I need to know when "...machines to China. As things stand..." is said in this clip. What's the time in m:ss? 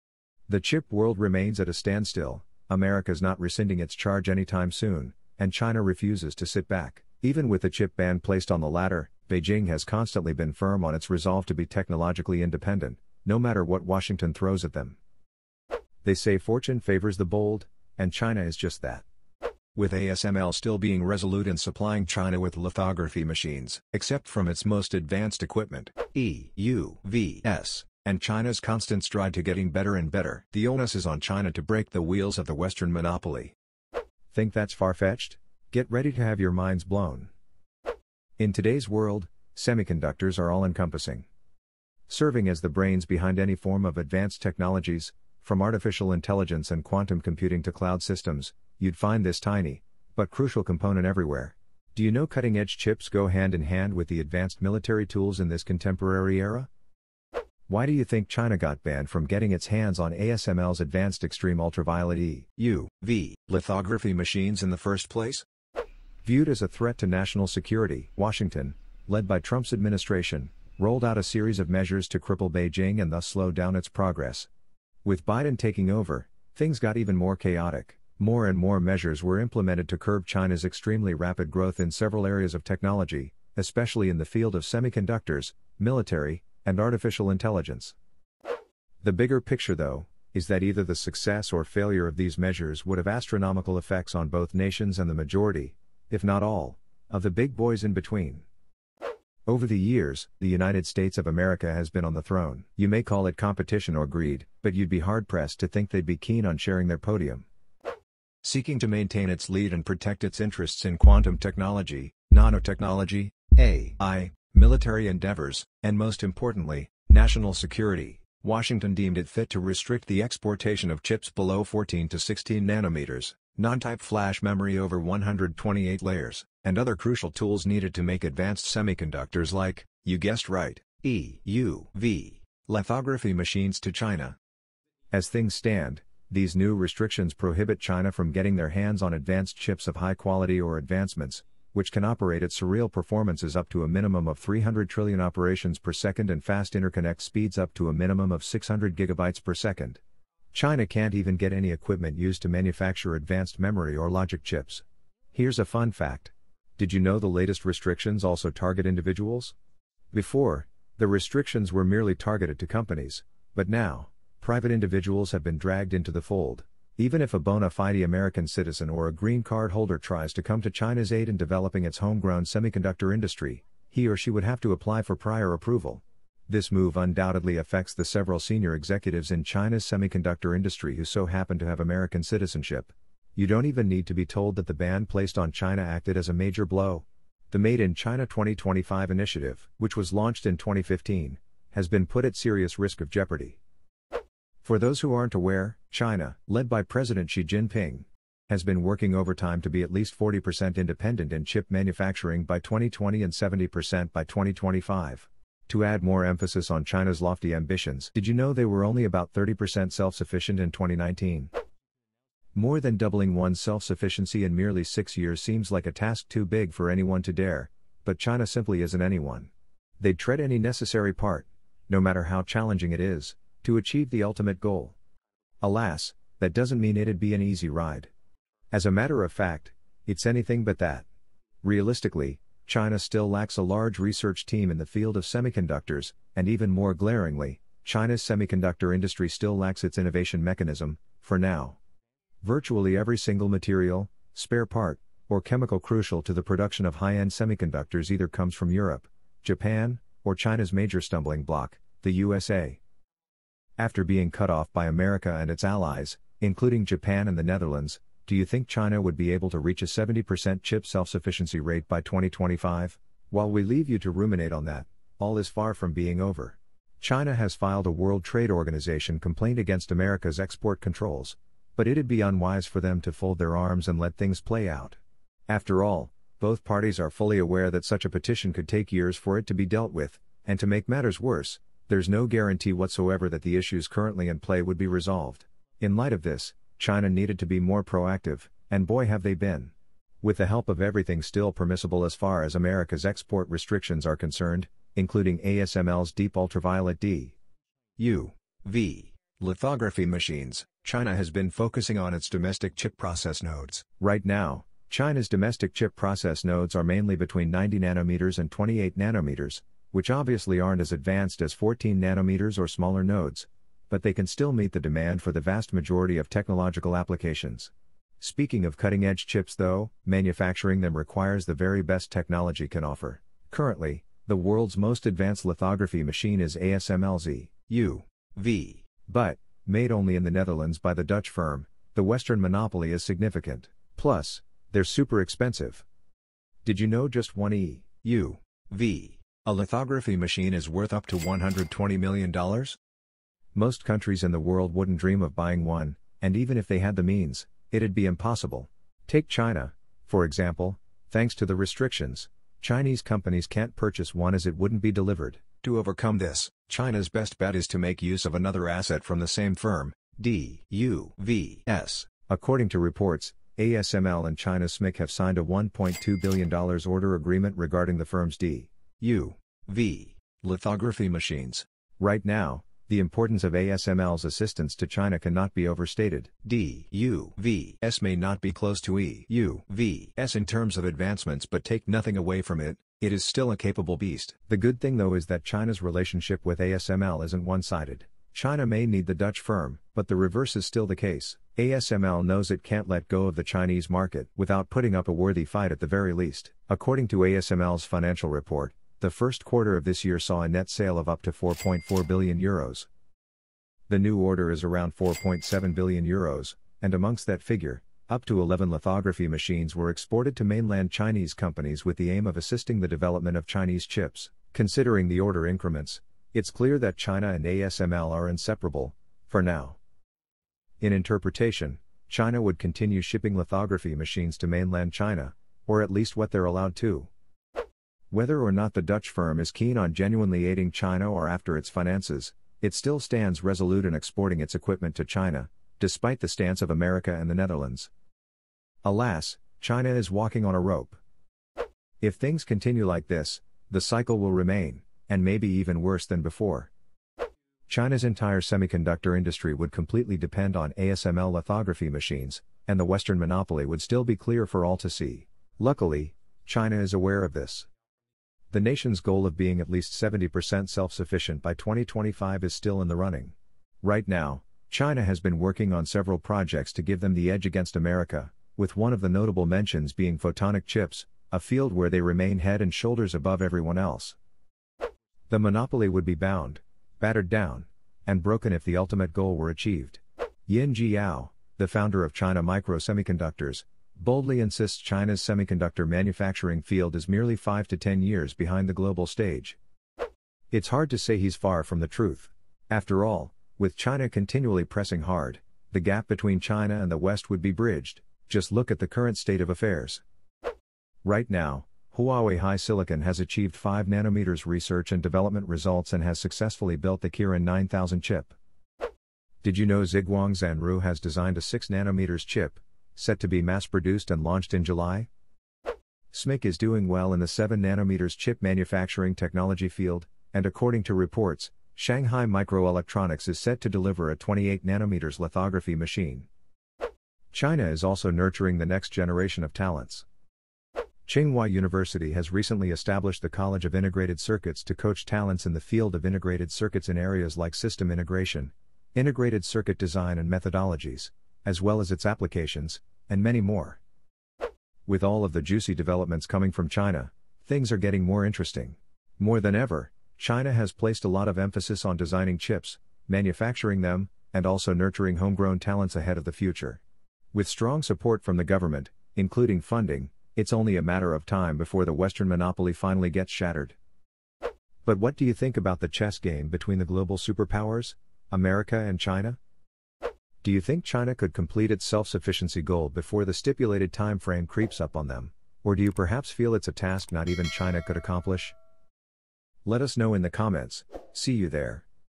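2:13.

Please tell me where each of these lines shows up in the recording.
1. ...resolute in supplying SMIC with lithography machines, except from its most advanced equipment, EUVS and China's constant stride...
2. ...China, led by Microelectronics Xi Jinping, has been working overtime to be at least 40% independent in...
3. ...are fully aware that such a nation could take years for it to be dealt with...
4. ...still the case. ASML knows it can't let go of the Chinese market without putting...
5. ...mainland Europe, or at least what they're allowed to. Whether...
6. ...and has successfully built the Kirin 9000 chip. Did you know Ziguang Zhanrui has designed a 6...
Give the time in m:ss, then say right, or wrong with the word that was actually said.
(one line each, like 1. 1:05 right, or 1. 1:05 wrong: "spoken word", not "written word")
1. 0:21 wrong: "China", not "SMIC"
2. 3:15 wrong: "President", not "Microelectronics"
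3. 4:36 wrong: "petition", not "nation"
4. 6:30 right
5. 7:04 wrong: "China", not "Europe"
6. 8:25 right.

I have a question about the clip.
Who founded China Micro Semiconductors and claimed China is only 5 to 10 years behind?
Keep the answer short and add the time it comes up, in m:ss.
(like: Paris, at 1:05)
Yin Jiao, at 8:00.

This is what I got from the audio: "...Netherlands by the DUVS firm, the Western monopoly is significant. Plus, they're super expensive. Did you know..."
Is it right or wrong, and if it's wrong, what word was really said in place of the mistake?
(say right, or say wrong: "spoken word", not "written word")
wrong: "Dutch", not "DUVS".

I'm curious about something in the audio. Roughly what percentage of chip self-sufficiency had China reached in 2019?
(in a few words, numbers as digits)
30%.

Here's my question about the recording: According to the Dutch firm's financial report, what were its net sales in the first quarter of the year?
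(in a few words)
4.4 billion euros.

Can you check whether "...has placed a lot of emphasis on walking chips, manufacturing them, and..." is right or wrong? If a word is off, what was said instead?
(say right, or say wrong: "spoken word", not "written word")
wrong: "designing", not "walking".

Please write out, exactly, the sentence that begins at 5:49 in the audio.
Take China, for example, thanks to the restrictions, Chinese companies can't purchase one as it wouldn't be delivered.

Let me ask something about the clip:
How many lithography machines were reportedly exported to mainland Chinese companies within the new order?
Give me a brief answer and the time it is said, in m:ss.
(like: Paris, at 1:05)
11, at 6:48.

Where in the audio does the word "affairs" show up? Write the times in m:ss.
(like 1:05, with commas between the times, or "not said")
8:19.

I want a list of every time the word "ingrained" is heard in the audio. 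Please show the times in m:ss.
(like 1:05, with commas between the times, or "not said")
not said.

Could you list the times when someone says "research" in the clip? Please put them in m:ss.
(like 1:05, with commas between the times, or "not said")
3:53, 8:24.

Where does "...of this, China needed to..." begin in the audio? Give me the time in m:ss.
4:46.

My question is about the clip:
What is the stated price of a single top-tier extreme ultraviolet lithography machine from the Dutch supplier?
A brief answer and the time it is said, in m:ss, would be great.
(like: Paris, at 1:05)
$120 million, at 5:41.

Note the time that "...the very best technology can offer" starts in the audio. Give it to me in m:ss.
5:21.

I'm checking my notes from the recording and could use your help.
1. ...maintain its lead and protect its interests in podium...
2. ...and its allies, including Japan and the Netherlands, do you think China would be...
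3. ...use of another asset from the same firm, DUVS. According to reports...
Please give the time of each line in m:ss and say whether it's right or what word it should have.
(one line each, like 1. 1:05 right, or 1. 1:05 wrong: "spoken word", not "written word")
1. 1:48 wrong: "quantum", not "podium"
2. 4:15 right
3. 5:58 right.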